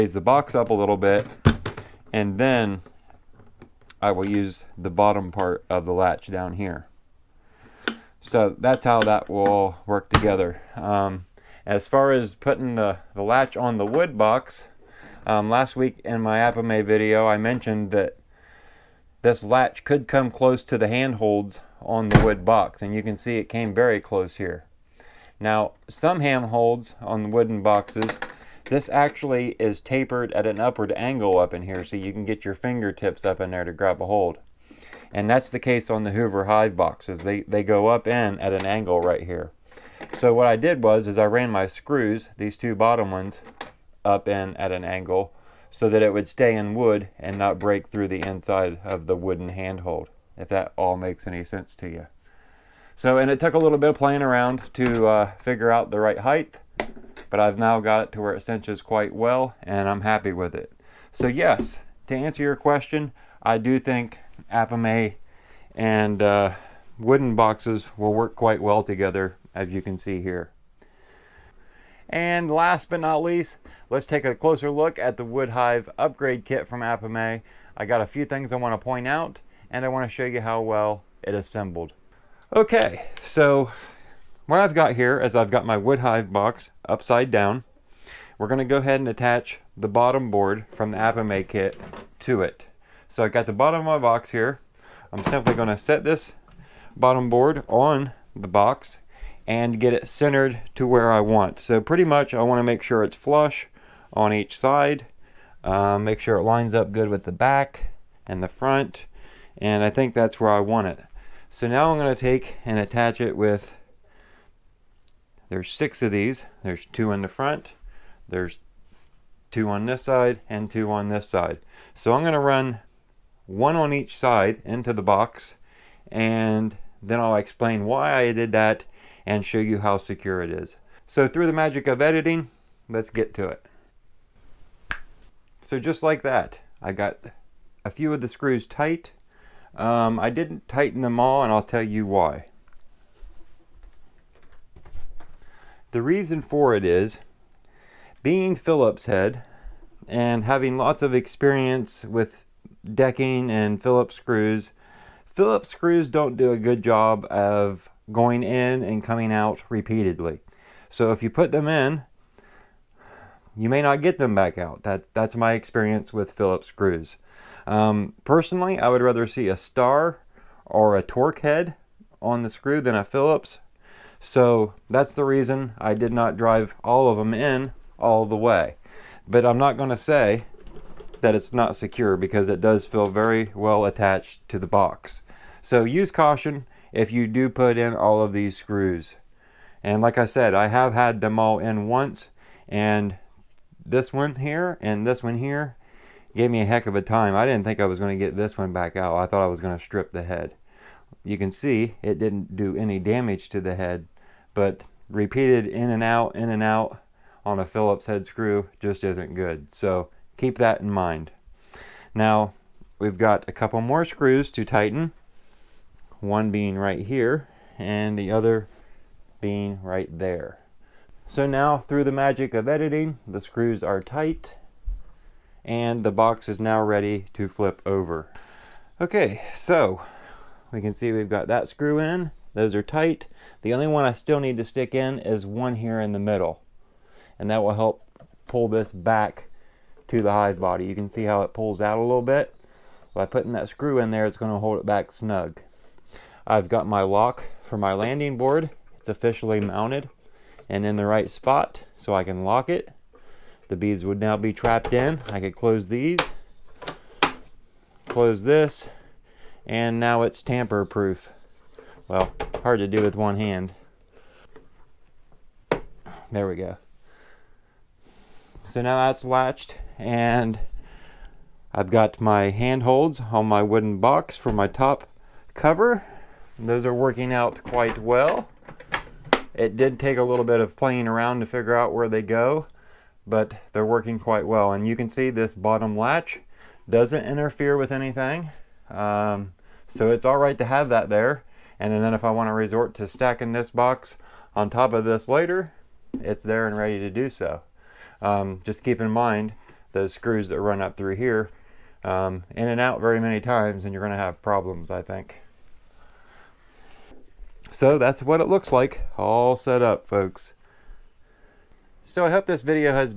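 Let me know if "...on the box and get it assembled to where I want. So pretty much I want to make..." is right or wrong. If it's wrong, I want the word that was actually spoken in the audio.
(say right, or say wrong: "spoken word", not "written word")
wrong: "centered", not "assembled".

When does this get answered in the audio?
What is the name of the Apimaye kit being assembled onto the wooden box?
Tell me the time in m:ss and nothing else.
1:15.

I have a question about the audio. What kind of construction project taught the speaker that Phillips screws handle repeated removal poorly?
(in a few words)
decking.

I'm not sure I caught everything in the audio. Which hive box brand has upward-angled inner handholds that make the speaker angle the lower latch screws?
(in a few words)
Hoover Hive.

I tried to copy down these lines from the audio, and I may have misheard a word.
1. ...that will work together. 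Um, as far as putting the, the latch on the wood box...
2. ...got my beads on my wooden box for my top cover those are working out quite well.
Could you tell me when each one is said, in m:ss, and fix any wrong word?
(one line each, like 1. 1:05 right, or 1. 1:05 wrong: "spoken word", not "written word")
1. 0:09 right
2. 4:31 wrong: "handholds", not "beads".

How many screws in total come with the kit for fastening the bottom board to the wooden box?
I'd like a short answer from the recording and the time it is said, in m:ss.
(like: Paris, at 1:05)
6, at 1:55.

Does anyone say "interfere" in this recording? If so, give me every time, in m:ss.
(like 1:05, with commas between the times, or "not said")
4:47.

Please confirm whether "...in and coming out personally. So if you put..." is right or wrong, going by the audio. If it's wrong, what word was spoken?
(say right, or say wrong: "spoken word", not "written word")
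wrong: "repeatedly", not "personally".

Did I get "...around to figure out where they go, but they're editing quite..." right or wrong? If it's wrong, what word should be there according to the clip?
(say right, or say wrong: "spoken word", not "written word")
wrong: "working", not "editing".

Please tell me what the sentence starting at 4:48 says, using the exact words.
Um, so it's all right to have that there.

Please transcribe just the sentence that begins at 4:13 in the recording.
The beads would now be trapped in.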